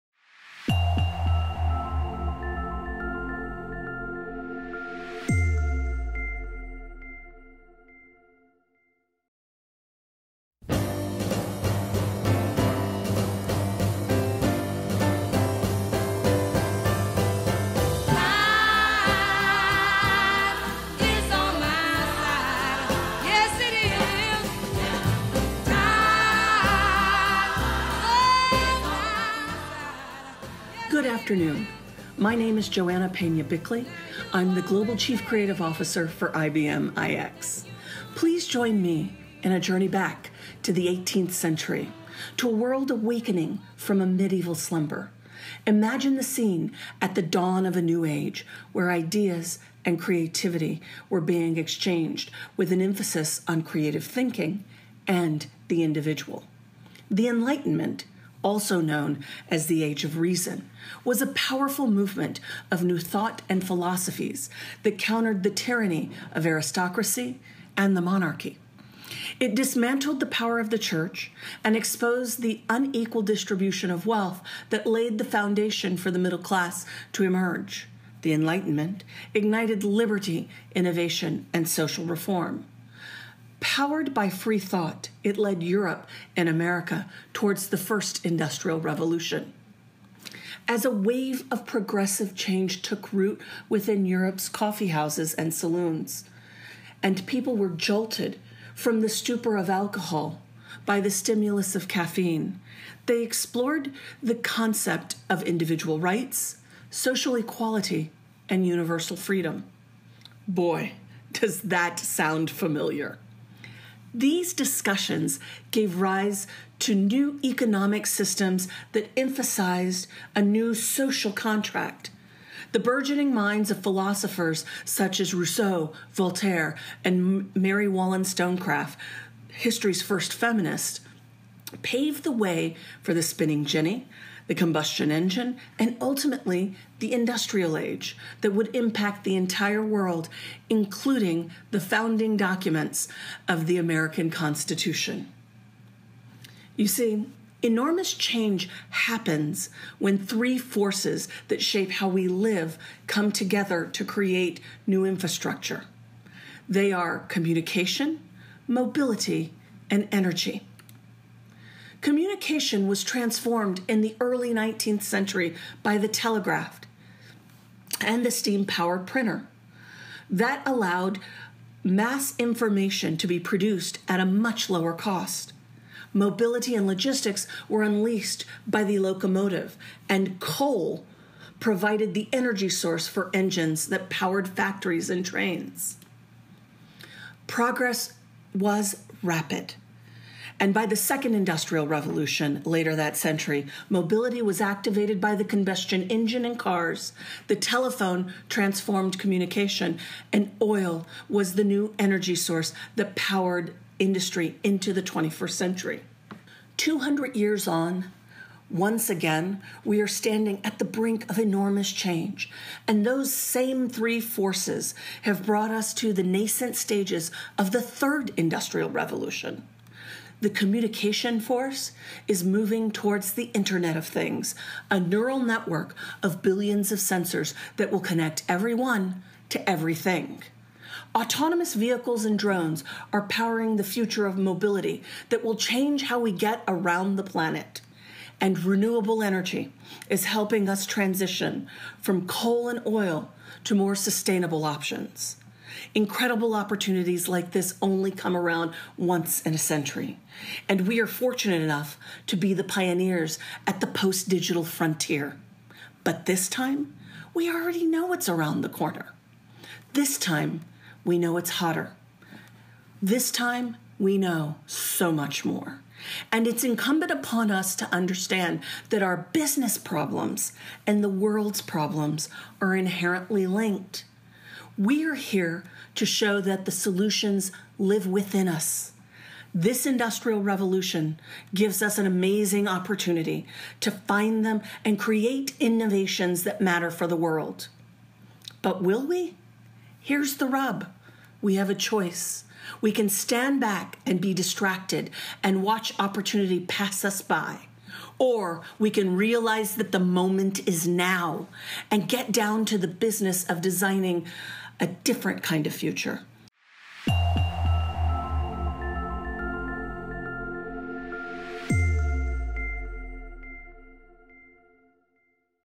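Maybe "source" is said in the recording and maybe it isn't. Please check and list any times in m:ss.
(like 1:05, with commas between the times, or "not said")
3:02, 3:22.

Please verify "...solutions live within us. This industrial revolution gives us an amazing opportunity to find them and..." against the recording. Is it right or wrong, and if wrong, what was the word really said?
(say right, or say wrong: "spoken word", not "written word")
right.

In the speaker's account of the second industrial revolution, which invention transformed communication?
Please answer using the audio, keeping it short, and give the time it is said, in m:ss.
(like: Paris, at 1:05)
the telephone, at 3:17.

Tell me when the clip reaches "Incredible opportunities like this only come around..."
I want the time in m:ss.
4:05.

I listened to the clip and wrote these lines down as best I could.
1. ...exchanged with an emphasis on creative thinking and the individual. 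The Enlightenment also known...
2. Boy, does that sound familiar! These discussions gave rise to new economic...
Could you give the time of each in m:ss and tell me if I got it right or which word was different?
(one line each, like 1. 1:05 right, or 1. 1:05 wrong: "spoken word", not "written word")
1. 0:51 right
2. 1:50 right.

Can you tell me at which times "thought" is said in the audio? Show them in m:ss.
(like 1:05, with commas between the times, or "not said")
1:02, 1:24.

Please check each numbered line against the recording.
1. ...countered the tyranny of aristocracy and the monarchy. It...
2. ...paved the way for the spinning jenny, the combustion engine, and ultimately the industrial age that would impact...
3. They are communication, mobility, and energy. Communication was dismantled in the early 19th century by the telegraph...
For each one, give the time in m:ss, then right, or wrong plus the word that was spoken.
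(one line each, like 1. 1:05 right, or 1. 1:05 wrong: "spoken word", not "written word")
1. 1:04 right
2. 2:11 right
3. 2:36 wrong: "transformed", not "dismantled".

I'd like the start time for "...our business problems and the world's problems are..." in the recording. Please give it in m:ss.
4:29.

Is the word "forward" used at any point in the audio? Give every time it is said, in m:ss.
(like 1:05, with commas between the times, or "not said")
not said.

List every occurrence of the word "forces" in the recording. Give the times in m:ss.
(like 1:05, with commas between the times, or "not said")
2:30, 3:34, 3:41.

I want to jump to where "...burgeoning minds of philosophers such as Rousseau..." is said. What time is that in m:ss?
2:02.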